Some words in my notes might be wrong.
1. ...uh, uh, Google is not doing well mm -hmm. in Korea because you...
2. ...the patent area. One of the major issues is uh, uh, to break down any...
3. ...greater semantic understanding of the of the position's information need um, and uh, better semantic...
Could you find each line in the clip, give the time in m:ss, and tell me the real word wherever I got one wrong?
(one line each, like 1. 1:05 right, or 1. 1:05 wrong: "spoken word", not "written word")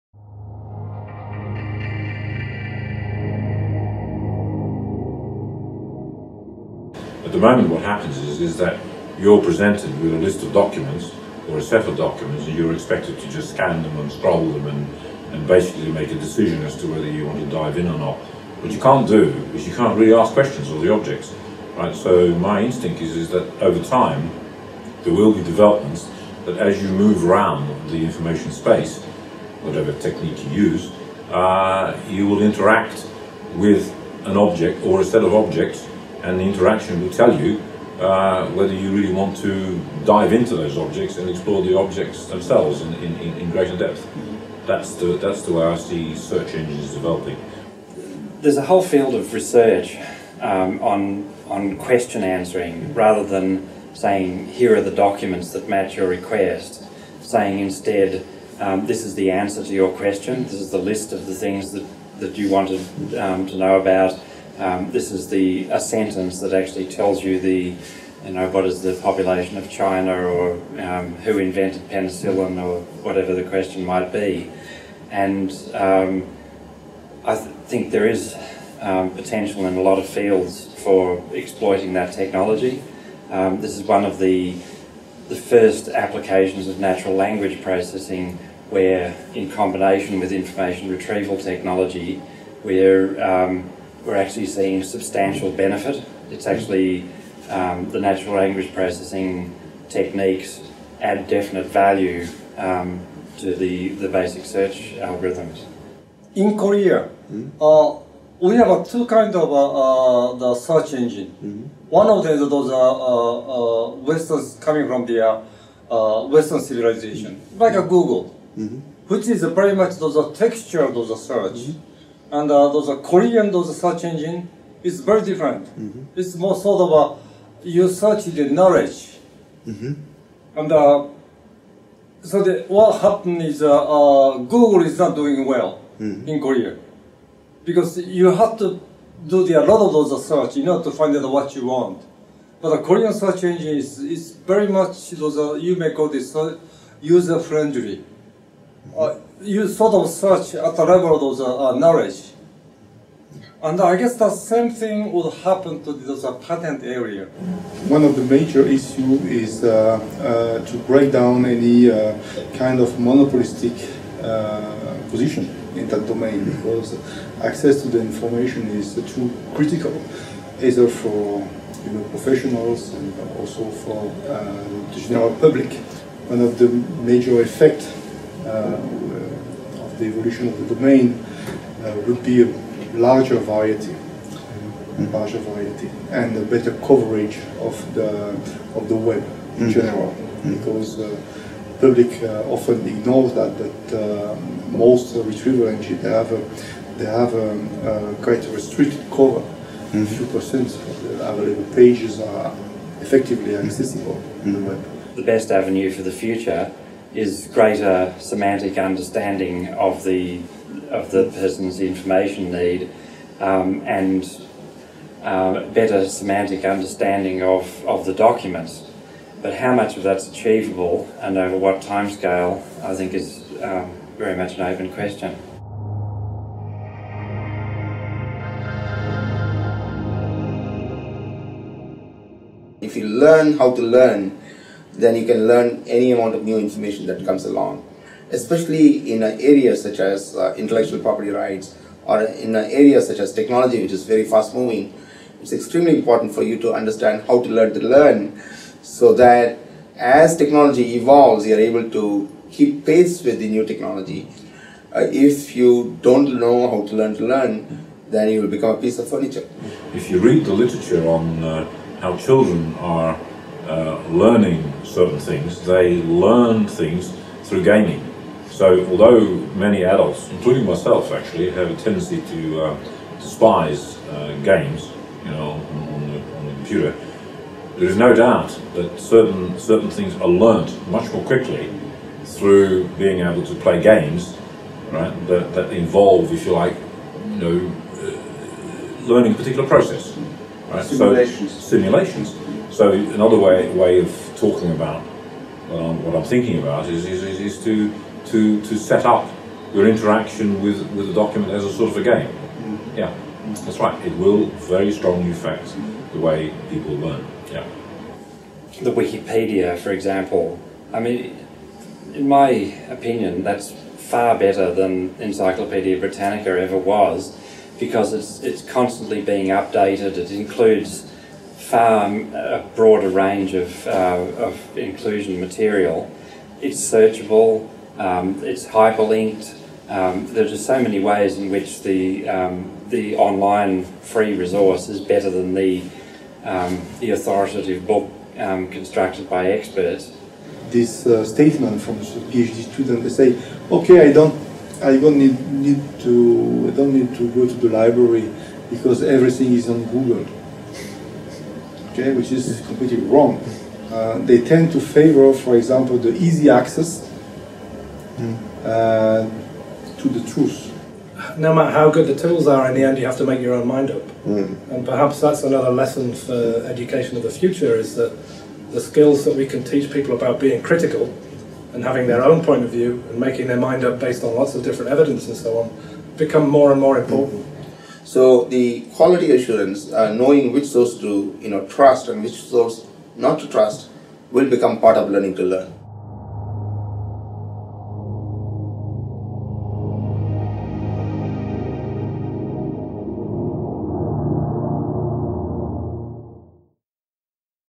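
1. 2:13 right
2. 2:36 right
3. 3:27 wrong: "person", not "position".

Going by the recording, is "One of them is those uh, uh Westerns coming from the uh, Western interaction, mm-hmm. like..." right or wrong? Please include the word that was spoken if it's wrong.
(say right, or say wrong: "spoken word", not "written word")
wrong: "civilization", not "interaction".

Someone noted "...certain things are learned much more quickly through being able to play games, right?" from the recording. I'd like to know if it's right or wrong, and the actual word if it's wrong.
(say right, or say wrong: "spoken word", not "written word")
right.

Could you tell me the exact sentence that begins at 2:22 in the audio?
But the Korean search engine is, is very much those uh, you may call this user friendly.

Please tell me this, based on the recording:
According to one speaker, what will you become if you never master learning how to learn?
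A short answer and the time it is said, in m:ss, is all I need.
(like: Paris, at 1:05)
a piece of furniture, at 4:18.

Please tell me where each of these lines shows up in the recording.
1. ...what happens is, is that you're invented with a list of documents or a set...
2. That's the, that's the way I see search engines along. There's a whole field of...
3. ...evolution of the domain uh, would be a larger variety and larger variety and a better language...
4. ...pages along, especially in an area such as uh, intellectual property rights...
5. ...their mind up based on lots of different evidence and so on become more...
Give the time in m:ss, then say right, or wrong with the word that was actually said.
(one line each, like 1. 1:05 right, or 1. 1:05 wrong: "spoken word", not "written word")
1. 0:07 wrong: "presented", not "invented"
2. 0:44 wrong: "developing", not "along"
3. 3:00 wrong: "coverage", not "language"
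4. 3:57 wrong: "comes", not "pages"
5. 6:13 right.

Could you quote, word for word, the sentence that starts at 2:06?
It's more sort of a, you search the knowledge, mm -hmm.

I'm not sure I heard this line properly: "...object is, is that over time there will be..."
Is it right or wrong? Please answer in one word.
wrong.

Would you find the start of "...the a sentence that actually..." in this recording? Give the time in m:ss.
1:05.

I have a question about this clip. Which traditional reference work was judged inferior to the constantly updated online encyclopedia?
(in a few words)
Encyclopedia Britannica.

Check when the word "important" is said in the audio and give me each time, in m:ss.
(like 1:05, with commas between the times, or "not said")
4:05, 6:16.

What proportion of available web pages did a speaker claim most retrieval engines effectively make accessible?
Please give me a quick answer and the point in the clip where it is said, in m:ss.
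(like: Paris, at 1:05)
few percent, at 3:20.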